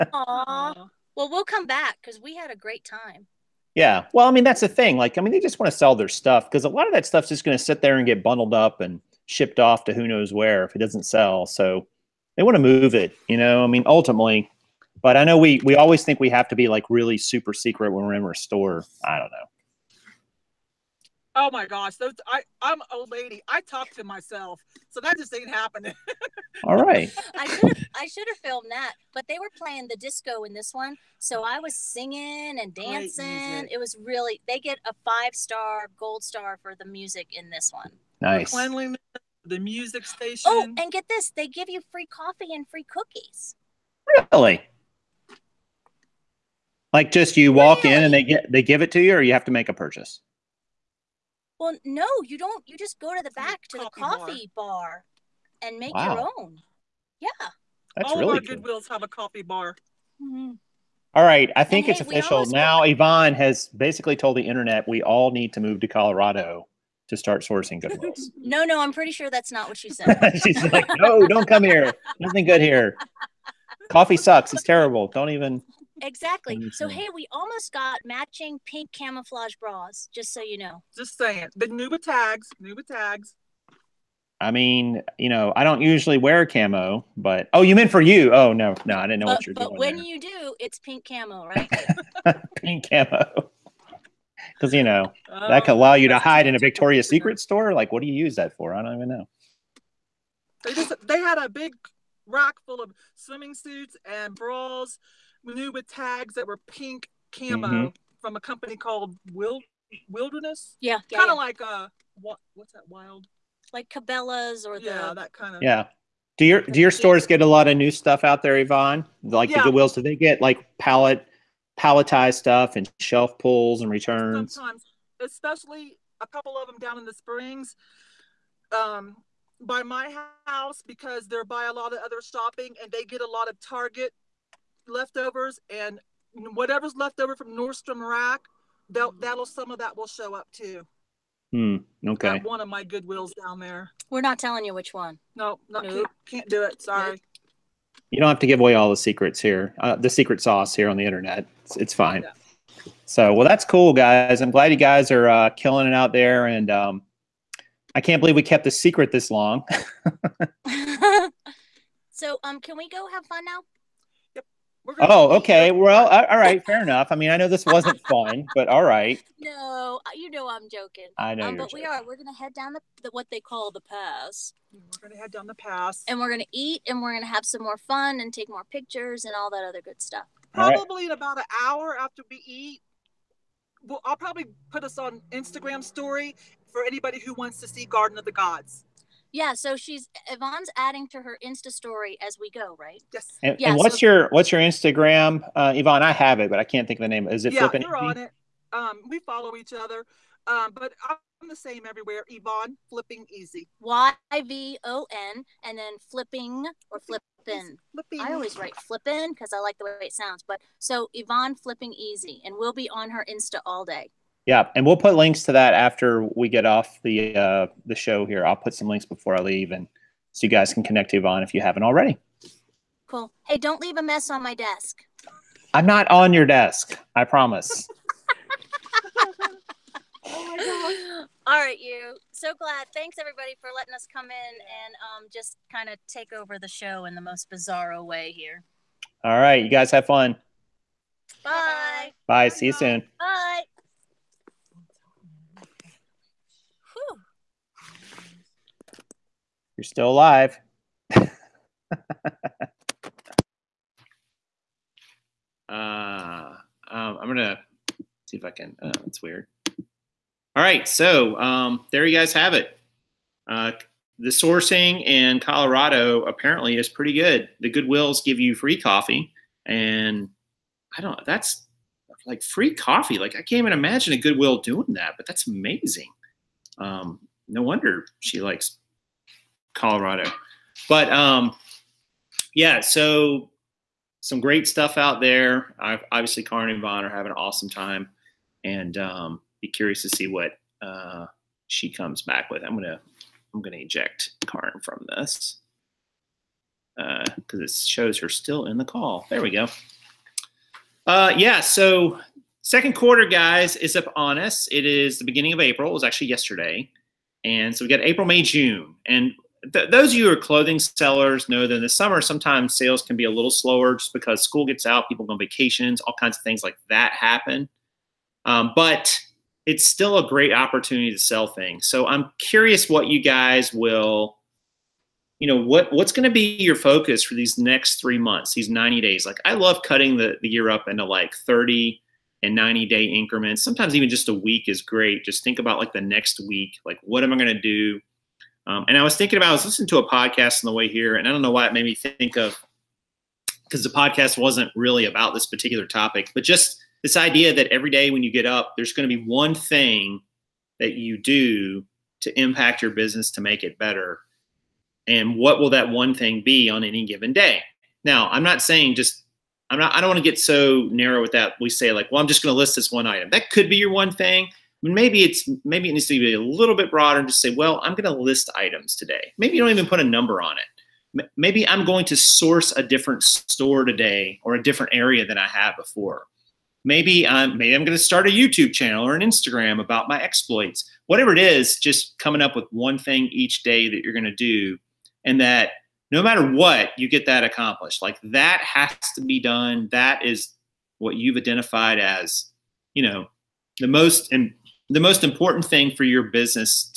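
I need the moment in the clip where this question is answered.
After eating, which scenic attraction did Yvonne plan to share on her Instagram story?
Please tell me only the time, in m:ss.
3:07.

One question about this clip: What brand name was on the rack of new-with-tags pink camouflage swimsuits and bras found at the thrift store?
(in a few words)
Wild Wilderness.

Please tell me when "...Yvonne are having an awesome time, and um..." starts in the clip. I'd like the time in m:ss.
4:46.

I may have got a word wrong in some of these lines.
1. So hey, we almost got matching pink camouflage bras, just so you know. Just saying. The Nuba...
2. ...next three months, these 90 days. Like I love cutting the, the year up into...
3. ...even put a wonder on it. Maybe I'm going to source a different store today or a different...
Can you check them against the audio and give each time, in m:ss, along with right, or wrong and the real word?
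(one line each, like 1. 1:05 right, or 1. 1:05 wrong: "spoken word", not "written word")
1. 1:16 right
2. 5:27 right
3. 6:09 wrong: "number", not "wonder".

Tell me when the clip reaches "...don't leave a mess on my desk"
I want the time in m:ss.
3:43.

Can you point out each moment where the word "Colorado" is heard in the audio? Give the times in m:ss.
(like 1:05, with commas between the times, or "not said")
1:05, 4:25, 4:39.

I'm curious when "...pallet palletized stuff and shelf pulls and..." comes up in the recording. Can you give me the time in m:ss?
2:00.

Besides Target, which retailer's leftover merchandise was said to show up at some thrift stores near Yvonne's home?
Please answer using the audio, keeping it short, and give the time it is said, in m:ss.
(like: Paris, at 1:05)
Nordstrom Rack, at 2:17.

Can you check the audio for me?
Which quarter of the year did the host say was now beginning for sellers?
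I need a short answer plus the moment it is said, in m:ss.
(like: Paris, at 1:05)
second quarter, at 5:02.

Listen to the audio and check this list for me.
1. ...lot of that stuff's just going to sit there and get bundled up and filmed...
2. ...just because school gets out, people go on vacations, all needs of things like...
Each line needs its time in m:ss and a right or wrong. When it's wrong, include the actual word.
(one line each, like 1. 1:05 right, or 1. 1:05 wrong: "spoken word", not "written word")
1. 0:06 wrong: "shipped", not "filmed"
2. 5:13 wrong: "kinds", not "needs".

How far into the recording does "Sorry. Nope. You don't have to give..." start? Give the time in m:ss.
2:26.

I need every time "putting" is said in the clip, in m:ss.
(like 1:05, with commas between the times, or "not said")
not said.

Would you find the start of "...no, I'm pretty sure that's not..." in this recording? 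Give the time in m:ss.
1:08.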